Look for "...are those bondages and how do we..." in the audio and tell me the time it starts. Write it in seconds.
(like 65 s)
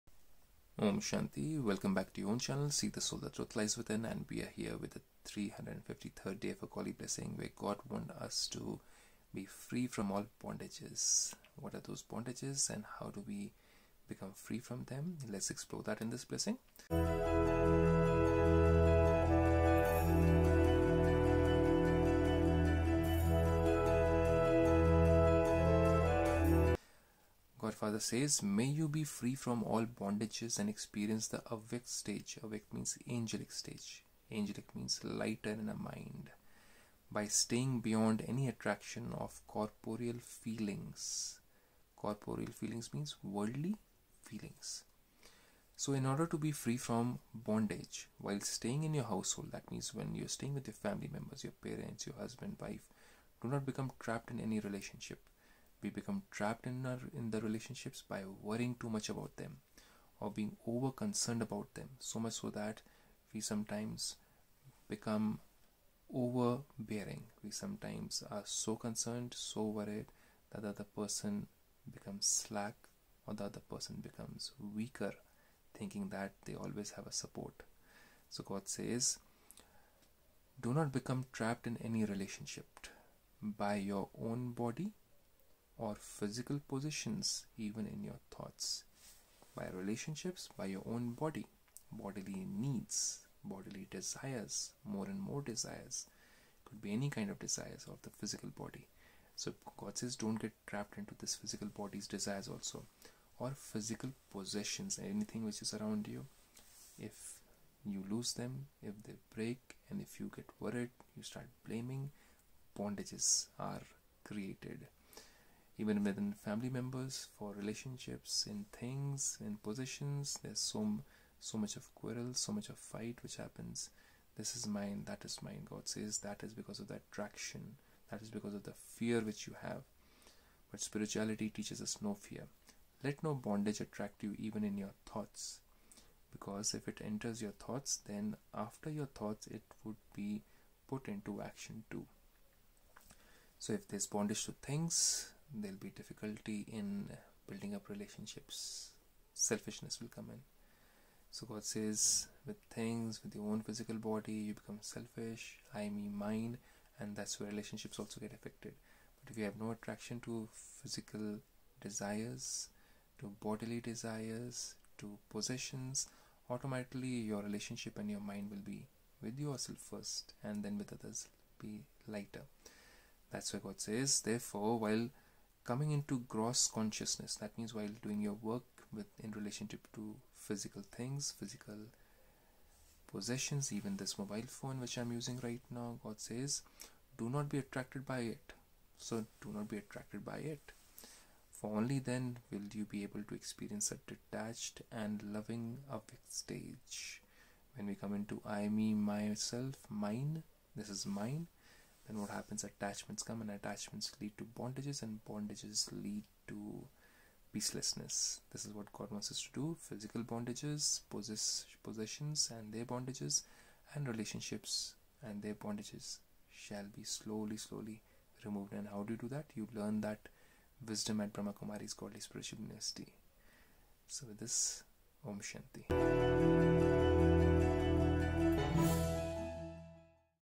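11 s.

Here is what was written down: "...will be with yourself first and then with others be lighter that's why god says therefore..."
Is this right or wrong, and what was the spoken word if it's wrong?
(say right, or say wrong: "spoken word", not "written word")
right.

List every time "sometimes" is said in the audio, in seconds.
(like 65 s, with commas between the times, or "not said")
63 s, 67 s.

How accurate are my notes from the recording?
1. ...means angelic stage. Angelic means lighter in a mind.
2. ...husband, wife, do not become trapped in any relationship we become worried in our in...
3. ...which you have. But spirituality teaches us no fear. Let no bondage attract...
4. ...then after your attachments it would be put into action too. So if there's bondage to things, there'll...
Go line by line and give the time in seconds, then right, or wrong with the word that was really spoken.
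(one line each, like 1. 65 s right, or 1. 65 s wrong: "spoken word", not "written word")
1. 32 s right
2. 52 s wrong: "trapped", not "worried"
3. 129 s right
4. 138 s wrong: "thoughts", not "attachments".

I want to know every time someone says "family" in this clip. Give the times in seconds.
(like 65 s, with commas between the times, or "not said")
50 s, 116 s.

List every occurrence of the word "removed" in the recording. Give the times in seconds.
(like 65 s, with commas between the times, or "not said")
218 s.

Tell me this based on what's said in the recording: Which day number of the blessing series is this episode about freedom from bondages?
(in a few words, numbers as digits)
353rd.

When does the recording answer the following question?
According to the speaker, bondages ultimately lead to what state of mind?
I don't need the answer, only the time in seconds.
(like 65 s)
207 s.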